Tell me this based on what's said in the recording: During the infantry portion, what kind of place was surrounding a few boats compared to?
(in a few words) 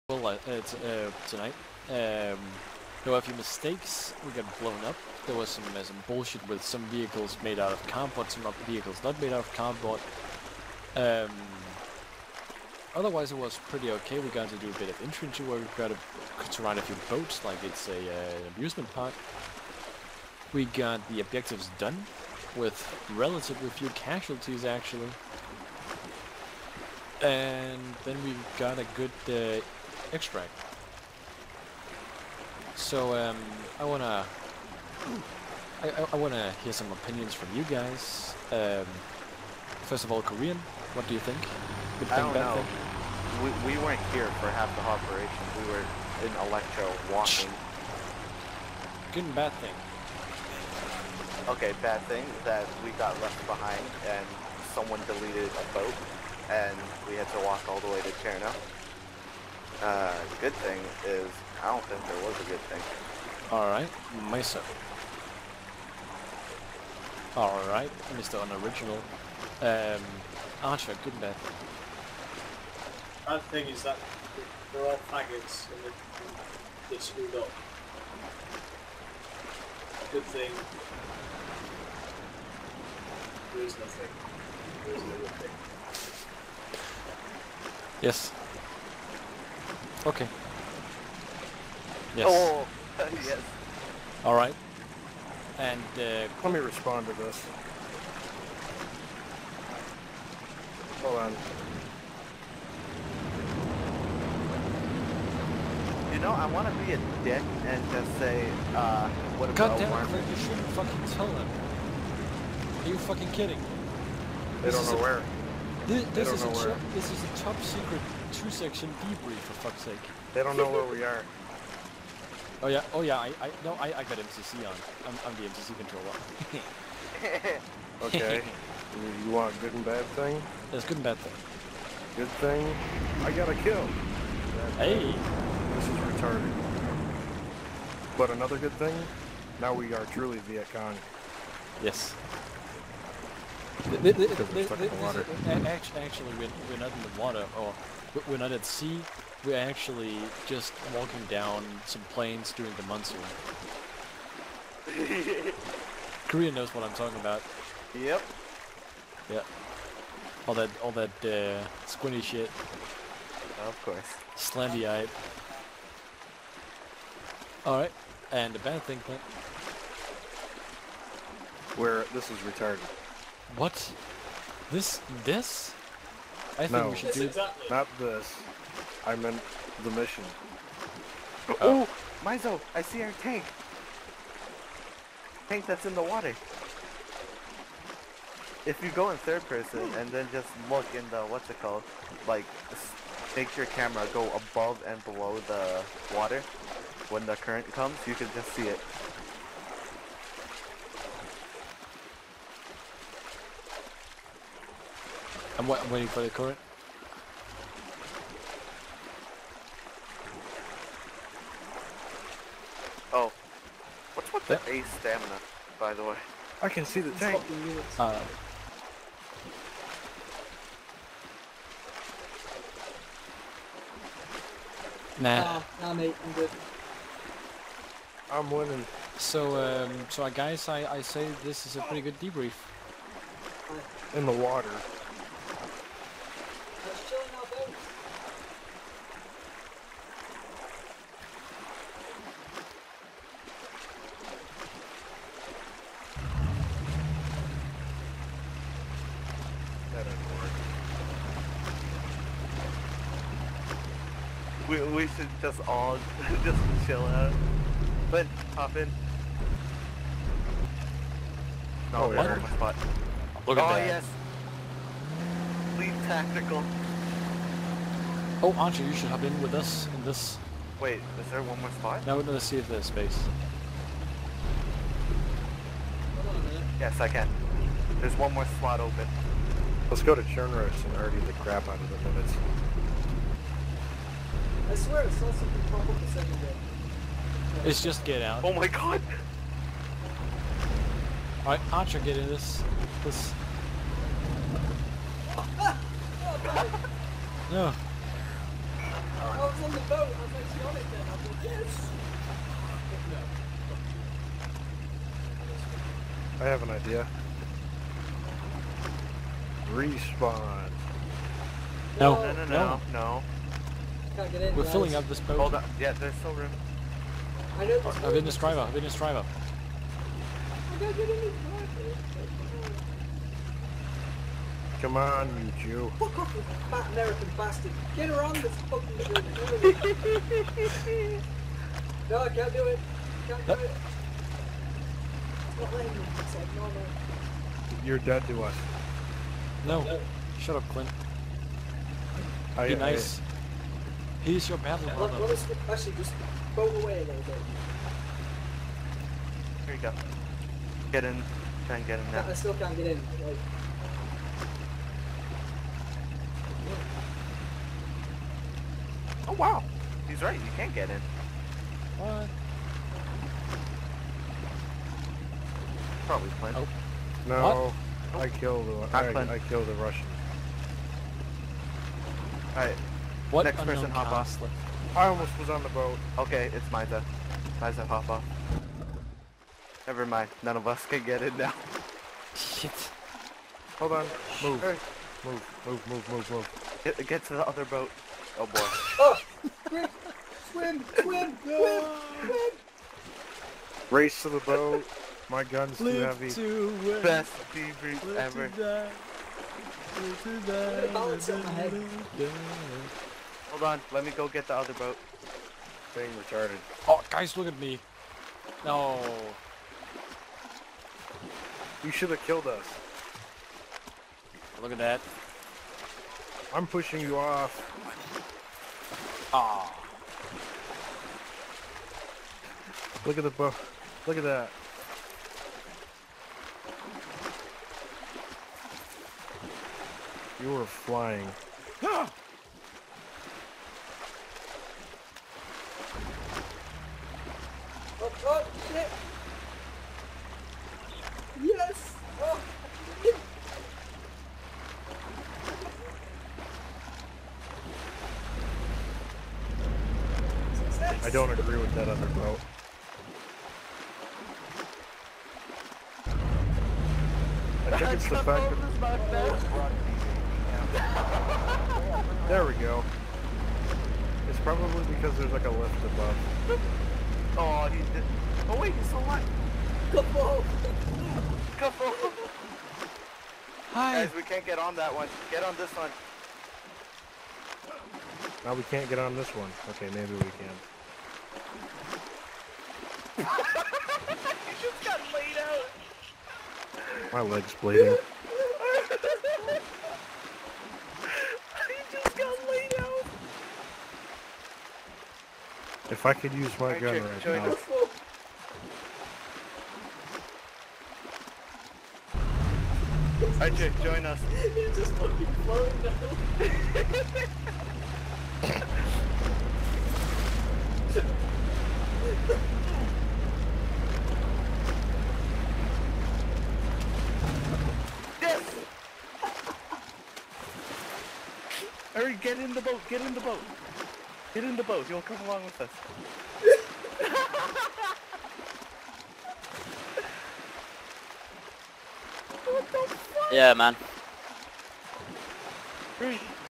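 An amusement park.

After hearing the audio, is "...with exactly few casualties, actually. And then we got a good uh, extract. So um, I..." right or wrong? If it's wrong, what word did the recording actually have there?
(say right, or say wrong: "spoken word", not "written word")
wrong: "relatively", not "exactly".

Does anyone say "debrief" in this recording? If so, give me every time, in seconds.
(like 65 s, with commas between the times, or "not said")
119 s, 232 s, 397 s.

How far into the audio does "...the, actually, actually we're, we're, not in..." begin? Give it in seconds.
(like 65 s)
144 s.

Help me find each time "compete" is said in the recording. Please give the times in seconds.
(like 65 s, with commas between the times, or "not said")
not said.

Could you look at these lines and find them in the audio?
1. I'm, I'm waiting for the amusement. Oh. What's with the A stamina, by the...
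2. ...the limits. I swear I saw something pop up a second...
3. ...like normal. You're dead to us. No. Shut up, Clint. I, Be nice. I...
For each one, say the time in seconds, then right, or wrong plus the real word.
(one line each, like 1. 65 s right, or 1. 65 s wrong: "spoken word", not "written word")
1. 205 s wrong: "current", not "amusement"
2. 282 s right
3. 336 s right.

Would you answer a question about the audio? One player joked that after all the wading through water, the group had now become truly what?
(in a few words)
Viet Cong.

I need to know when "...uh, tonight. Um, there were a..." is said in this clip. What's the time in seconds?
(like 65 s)
0 s.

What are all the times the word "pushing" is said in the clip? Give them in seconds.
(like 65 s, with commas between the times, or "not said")
416 s.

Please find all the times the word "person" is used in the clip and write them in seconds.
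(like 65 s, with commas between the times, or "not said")
189 s, 373 s.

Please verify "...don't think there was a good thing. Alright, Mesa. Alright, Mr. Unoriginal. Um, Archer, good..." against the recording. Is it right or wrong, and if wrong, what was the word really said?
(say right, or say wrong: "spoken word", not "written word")
right.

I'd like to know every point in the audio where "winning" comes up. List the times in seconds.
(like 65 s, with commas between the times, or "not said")
228 s.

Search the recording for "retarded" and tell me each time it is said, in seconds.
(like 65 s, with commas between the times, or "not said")
135 s, 172 s, 406 s.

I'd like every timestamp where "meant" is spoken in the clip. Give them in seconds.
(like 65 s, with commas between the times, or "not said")
179 s.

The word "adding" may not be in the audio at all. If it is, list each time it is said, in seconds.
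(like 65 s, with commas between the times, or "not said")
not said.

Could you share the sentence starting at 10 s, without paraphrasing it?
Um, otherwise, it was pretty okay.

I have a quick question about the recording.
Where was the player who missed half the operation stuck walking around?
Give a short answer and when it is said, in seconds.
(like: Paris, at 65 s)
Electro, at 46 s.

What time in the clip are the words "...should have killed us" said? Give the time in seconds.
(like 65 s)
411 s.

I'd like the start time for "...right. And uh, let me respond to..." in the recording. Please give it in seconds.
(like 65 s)
94 s.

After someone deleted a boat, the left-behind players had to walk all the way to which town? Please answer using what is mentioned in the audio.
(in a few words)
Cherno.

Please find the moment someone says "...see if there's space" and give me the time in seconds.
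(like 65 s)
272 s.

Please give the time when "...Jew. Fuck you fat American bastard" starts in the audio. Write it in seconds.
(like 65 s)
325 s.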